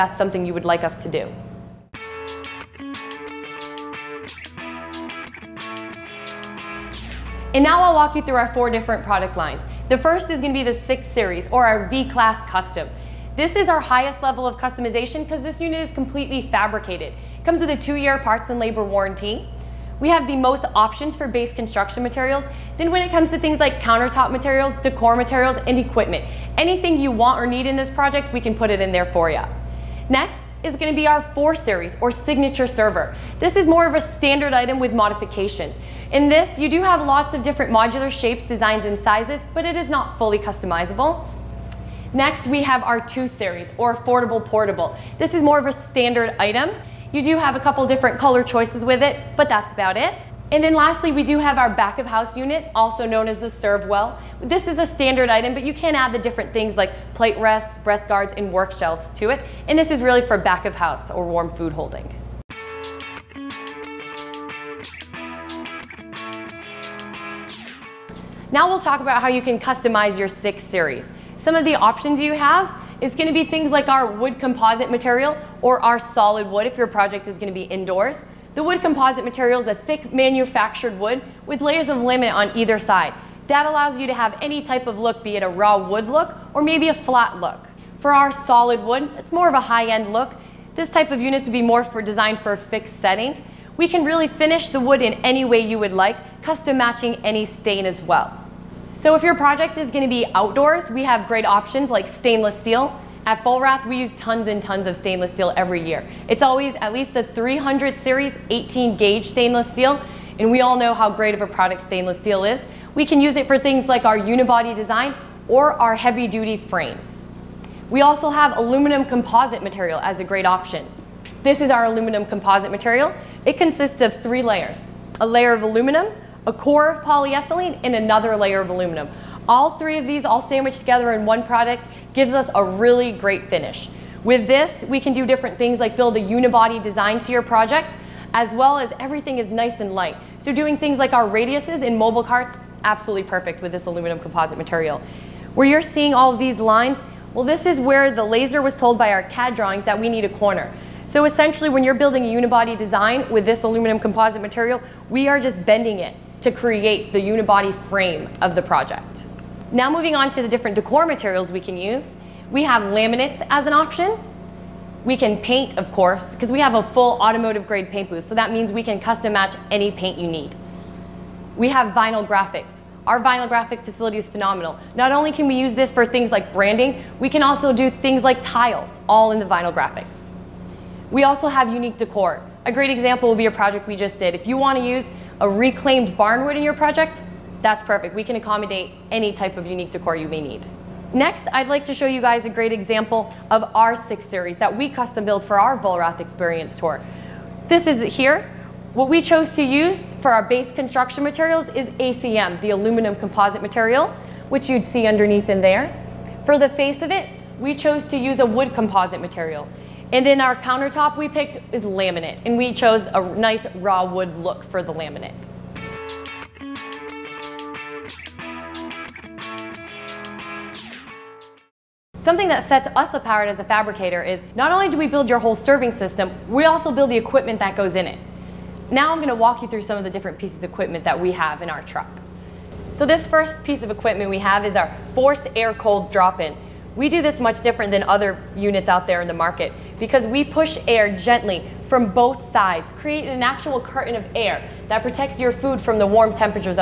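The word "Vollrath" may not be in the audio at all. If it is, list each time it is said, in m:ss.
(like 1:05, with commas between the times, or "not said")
1:43, 3:15.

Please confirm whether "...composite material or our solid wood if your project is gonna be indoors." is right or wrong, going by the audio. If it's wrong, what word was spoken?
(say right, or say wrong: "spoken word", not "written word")
right.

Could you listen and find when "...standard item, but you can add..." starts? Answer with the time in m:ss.
0:54.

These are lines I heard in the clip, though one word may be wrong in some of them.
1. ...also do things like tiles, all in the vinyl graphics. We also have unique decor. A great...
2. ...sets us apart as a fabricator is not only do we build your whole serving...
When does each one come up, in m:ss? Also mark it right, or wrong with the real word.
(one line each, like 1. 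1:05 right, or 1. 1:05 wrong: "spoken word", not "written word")
1. 2:57 right
2. 3:42 right.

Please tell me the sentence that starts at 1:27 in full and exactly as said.
For our solid wood, it's more of a high-end look.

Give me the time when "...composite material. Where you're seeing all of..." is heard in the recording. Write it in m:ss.
2:24.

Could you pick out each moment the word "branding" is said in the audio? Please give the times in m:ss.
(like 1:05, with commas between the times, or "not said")
2:56.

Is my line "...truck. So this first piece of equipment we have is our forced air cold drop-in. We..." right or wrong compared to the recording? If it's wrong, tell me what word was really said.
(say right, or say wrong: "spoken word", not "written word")
right.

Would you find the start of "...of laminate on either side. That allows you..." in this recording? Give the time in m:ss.
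1:21.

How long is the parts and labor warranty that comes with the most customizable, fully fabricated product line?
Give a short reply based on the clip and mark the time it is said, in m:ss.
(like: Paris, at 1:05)
2 years, at 0:17.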